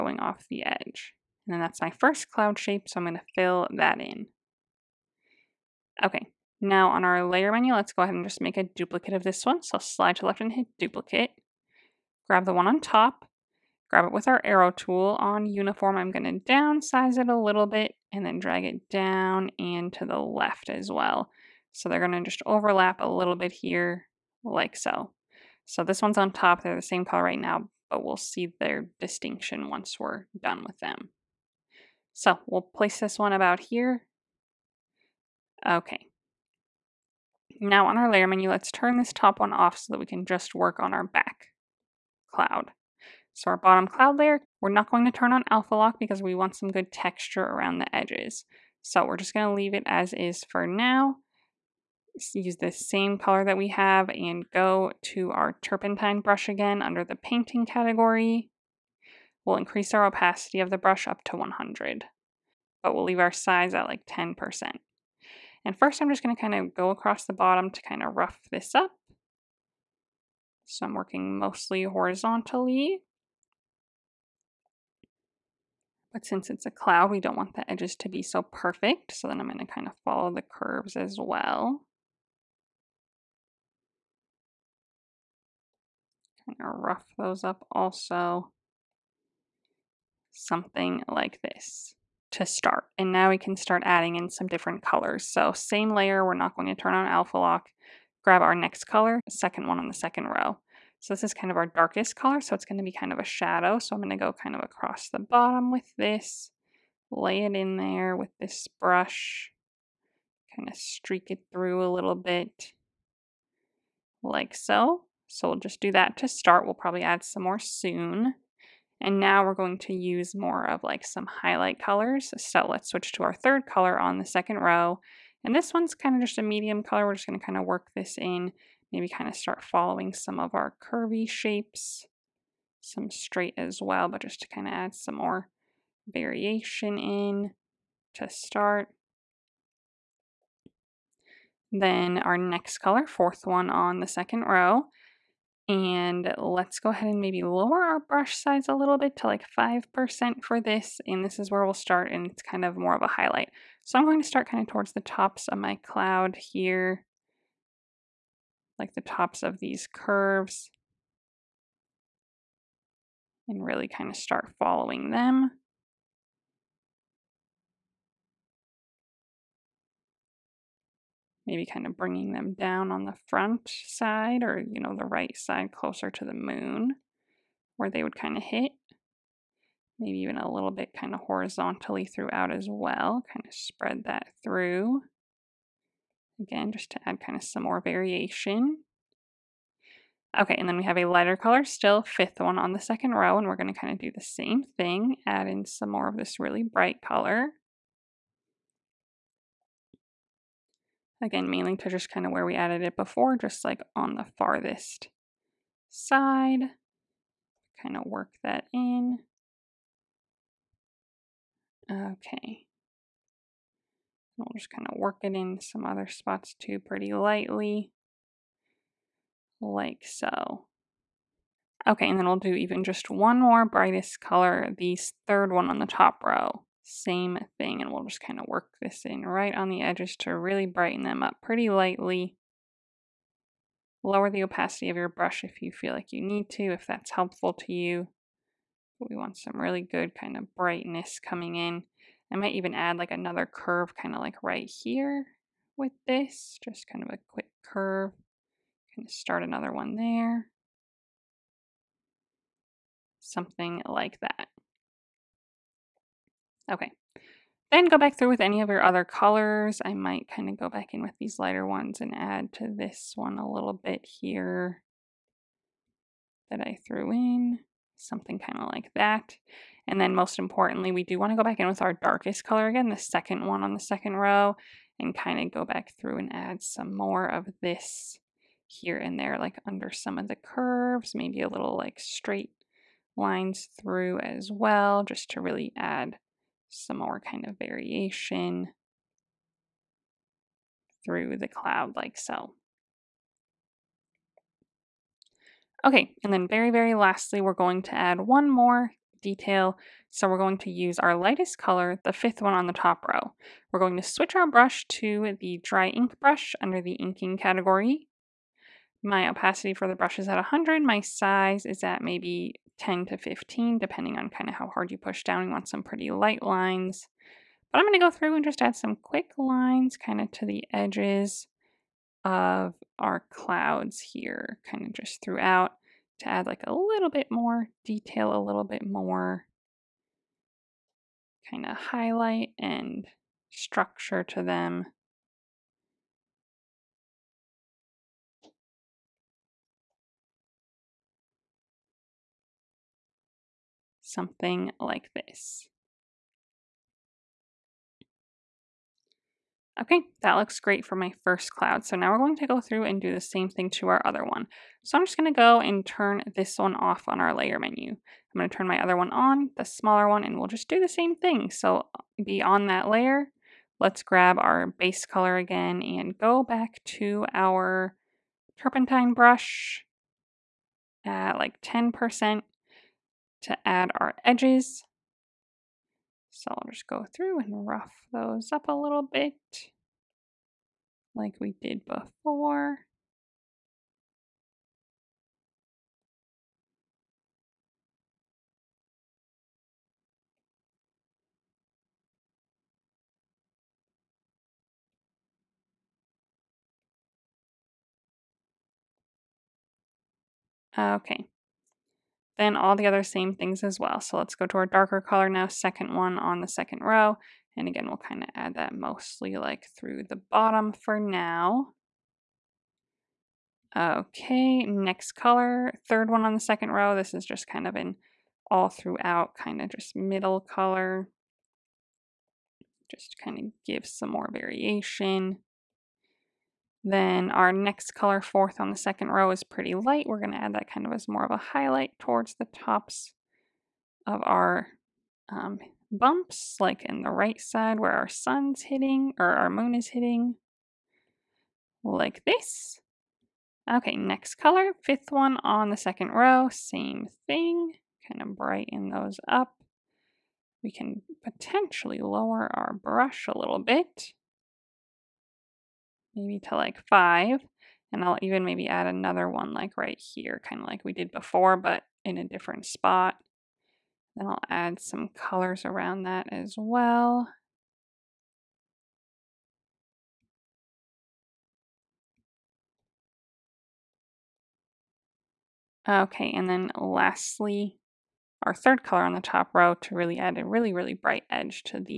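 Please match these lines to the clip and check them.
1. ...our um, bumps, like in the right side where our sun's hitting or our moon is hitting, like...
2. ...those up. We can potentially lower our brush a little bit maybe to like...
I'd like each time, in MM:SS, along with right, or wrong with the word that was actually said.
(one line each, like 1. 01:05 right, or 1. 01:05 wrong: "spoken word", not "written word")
1. 07:14 right
2. 07:28 right.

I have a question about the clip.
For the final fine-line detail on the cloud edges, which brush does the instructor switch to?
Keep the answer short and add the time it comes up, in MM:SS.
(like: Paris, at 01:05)
dry ink brush, at 05:05.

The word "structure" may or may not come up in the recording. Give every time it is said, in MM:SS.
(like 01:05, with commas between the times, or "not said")
05:33.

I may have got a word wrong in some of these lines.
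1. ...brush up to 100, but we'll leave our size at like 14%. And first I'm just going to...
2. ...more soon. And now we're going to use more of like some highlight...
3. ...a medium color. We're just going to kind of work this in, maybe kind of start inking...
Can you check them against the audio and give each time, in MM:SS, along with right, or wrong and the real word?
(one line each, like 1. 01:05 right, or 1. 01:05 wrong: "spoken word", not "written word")
1. 01:00 wrong: "10", not "14"
2. 01:57 right
3. 02:06 wrong: "following", not "inking".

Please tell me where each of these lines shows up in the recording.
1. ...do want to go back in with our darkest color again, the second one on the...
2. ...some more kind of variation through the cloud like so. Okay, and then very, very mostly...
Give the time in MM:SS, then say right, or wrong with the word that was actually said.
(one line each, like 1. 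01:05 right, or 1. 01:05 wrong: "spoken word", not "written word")
1. 04:31 right
2. 04:46 wrong: "lastly", not "mostly".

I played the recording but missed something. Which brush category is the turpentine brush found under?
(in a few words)
painting.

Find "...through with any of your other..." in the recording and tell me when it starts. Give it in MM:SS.
04:18.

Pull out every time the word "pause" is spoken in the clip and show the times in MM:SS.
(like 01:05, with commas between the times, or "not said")
not said.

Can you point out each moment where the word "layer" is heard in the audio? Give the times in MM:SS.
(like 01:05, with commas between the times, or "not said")
00:07, 00:38, 00:44, 01:35, 05:57, 06:02.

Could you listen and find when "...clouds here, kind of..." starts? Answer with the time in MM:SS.
05:23.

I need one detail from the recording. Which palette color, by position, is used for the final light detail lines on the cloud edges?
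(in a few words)
fifth one on the top row.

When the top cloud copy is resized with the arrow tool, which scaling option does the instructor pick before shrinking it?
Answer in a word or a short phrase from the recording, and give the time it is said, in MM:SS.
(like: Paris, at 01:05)
Uniform, at 00:15.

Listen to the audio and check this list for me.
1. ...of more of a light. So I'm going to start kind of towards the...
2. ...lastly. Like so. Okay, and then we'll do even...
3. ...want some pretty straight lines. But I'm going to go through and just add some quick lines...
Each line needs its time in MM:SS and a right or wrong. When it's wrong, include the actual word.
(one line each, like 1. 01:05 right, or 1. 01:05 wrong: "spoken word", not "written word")
1. 02:32 wrong: "highlight", not "light"
2. 03:37 wrong: "lightly", not "lastly"
3. 05:15 wrong: "light", not "straight".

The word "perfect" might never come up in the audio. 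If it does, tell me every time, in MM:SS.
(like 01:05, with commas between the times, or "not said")
01:18.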